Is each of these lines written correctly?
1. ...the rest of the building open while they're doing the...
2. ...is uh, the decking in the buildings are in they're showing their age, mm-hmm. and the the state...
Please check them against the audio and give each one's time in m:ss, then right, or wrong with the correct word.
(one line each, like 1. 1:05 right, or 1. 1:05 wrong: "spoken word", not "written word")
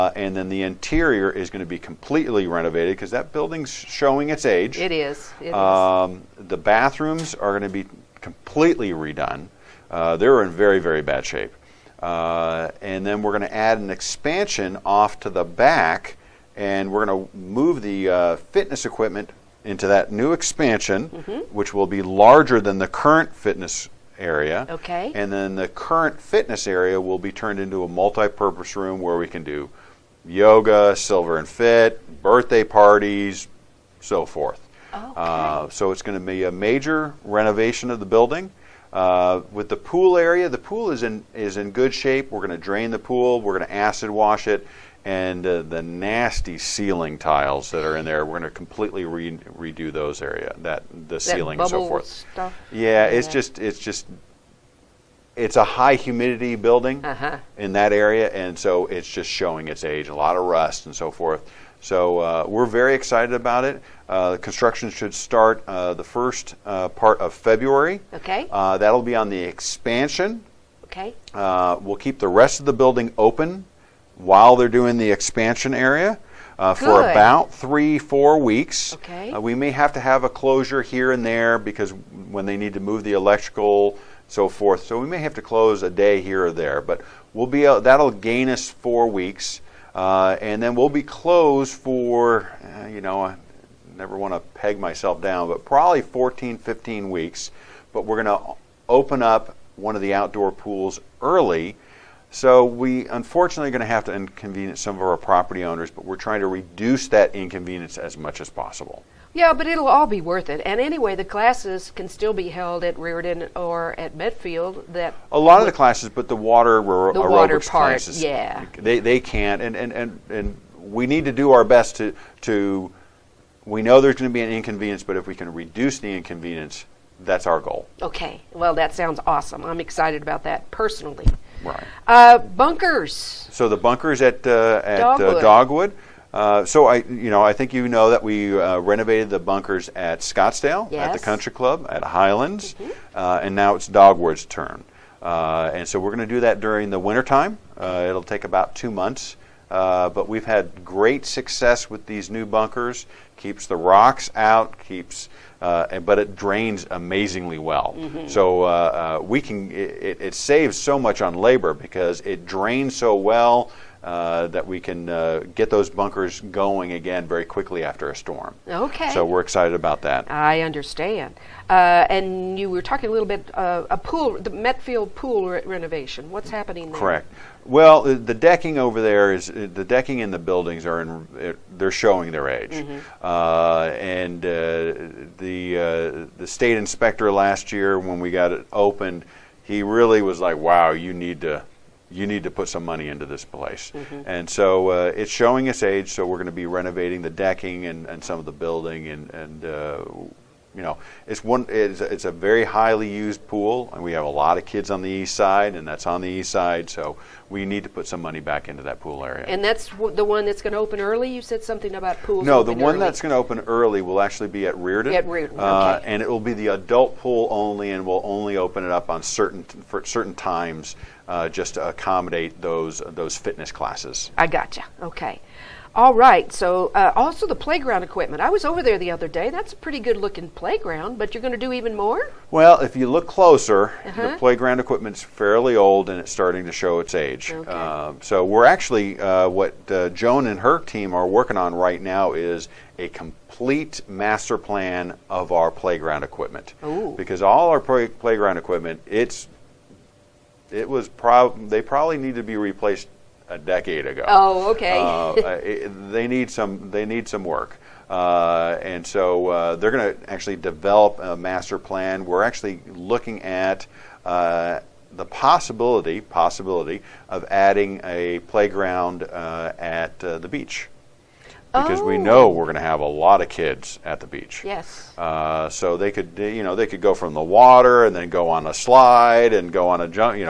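1. 1:12 right
2. 2:59 right.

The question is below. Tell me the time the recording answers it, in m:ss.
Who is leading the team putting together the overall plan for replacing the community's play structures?
4:00.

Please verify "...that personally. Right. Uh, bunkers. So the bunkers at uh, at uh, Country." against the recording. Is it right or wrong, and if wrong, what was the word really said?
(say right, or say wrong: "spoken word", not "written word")
wrong: "Dogwood", not "Country".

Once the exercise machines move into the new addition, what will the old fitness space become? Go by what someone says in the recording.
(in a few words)
multi-purpose room.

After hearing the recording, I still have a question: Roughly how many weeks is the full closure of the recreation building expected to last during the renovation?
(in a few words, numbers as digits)
14 to 15 weeks.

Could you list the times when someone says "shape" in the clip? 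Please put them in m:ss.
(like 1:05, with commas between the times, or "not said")
0:11, 0:41.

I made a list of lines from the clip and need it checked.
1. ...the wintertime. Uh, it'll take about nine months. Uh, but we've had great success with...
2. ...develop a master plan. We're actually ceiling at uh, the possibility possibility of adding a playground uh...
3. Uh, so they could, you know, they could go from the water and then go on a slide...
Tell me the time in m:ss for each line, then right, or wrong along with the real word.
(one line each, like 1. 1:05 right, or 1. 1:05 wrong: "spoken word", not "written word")
1. 2:26 wrong: "two", not "nine"
2. 4:20 wrong: "looking", not "ceiling"
3. 4:35 right.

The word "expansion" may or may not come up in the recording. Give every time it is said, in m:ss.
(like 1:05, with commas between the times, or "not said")
0:13, 0:20, 1:09, 1:15.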